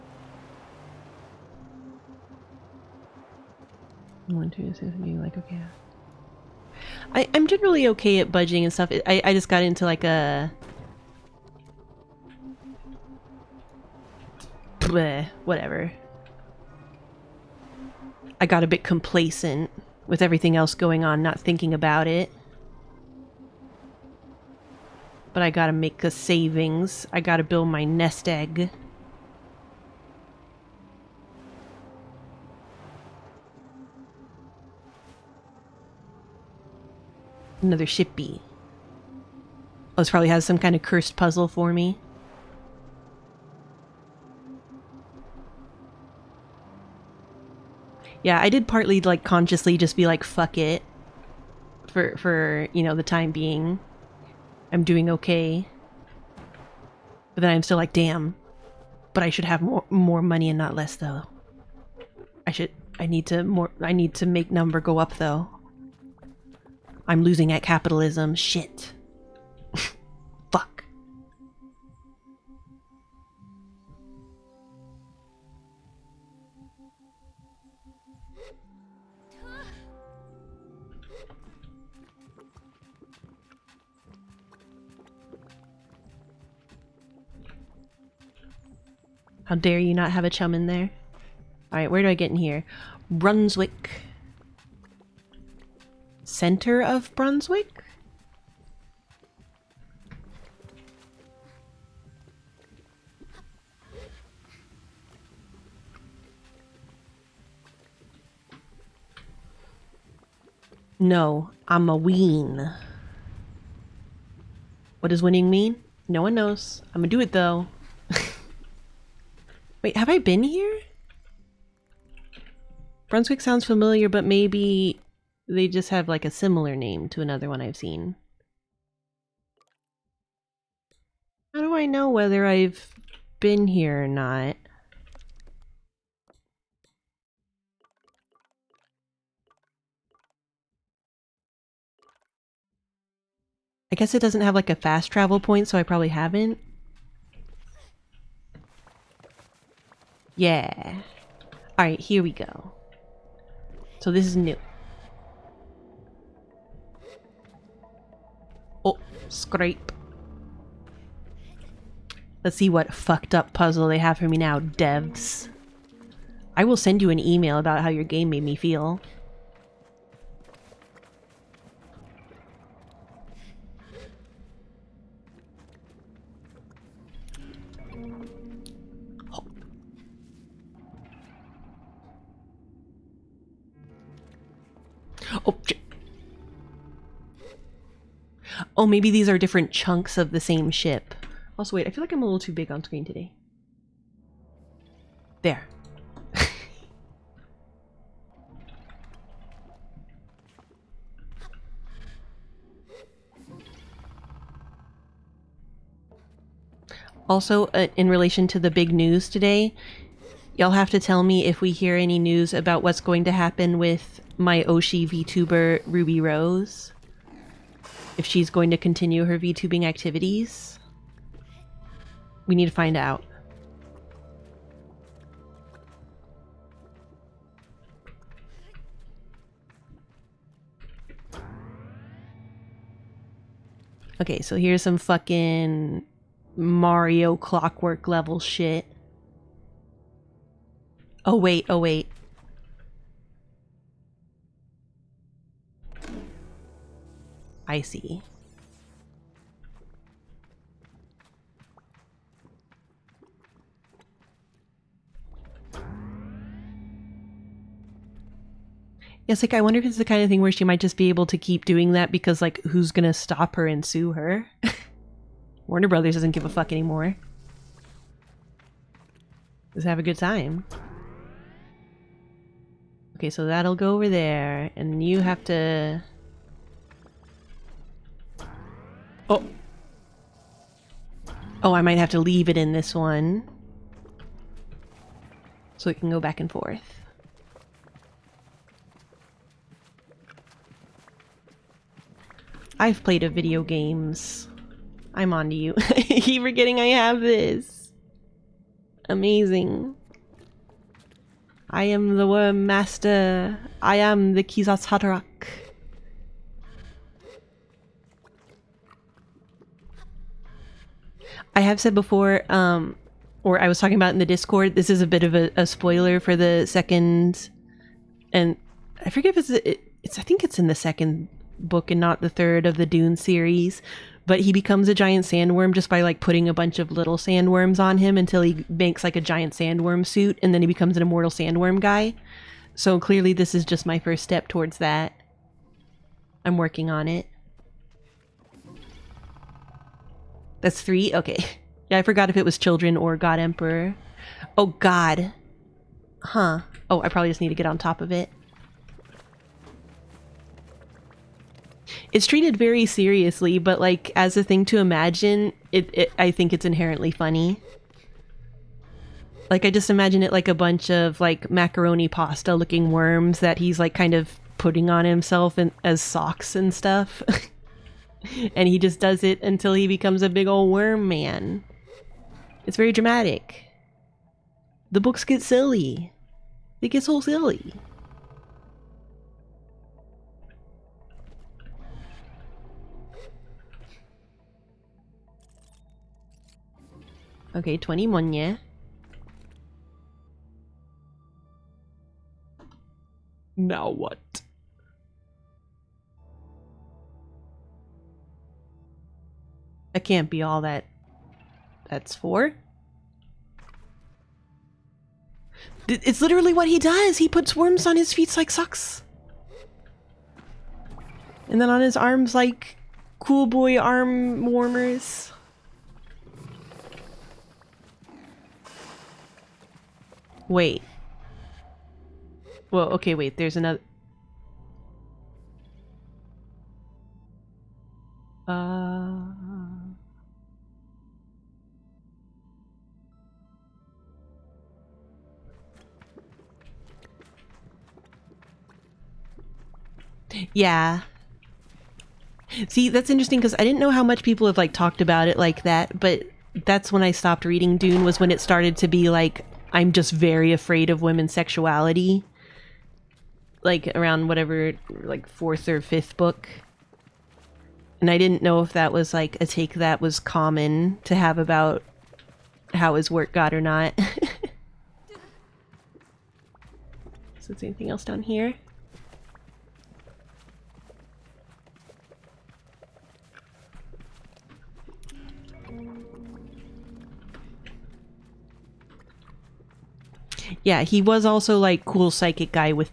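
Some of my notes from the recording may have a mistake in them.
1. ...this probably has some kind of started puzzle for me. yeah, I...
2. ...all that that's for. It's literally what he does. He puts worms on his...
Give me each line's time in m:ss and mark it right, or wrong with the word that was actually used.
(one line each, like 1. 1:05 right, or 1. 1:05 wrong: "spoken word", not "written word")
1. 0:40 wrong: "cursed", not "started"
2. 6:40 right.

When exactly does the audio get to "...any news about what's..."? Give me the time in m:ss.
3:31.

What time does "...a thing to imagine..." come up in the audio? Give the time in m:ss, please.
5:54.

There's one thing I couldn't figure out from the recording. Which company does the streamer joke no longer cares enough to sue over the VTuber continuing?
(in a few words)
Warner Brothers.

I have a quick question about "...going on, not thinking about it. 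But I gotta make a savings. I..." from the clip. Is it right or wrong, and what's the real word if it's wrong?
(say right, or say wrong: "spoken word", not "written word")
right.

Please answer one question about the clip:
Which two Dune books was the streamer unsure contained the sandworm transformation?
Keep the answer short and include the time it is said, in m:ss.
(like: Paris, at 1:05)
Children or God Emperor, at 5:42.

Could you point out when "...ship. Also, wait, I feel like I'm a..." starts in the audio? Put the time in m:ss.
3:10.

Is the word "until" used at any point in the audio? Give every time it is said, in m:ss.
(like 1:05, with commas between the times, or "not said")
5:28, 6:09.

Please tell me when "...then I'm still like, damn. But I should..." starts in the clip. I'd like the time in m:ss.
0:57.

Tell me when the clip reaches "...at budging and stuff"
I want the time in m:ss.
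0:08.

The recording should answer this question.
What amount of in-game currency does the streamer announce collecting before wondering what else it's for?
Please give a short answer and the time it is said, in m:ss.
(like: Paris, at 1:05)
20, at 6:27.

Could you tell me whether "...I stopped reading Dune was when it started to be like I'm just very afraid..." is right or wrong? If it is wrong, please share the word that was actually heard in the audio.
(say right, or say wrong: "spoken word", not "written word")
right.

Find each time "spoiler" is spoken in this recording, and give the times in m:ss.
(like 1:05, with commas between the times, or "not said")
5:15.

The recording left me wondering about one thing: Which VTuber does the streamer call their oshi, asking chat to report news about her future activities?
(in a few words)
Ruby Rose.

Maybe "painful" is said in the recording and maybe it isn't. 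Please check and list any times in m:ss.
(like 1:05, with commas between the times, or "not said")
not said.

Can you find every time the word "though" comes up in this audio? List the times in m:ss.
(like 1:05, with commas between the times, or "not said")
1:00, 1:05, 1:57.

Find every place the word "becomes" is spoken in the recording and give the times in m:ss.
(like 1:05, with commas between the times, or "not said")
5:24, 5:30, 6:09.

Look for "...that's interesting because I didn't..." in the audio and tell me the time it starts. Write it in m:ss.
7:22.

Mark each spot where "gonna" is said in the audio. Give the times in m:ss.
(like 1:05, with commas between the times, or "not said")
1:56, 4:22.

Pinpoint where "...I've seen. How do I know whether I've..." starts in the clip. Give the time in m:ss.
2:07.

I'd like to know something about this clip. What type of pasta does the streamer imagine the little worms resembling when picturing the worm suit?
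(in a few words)
macaroni.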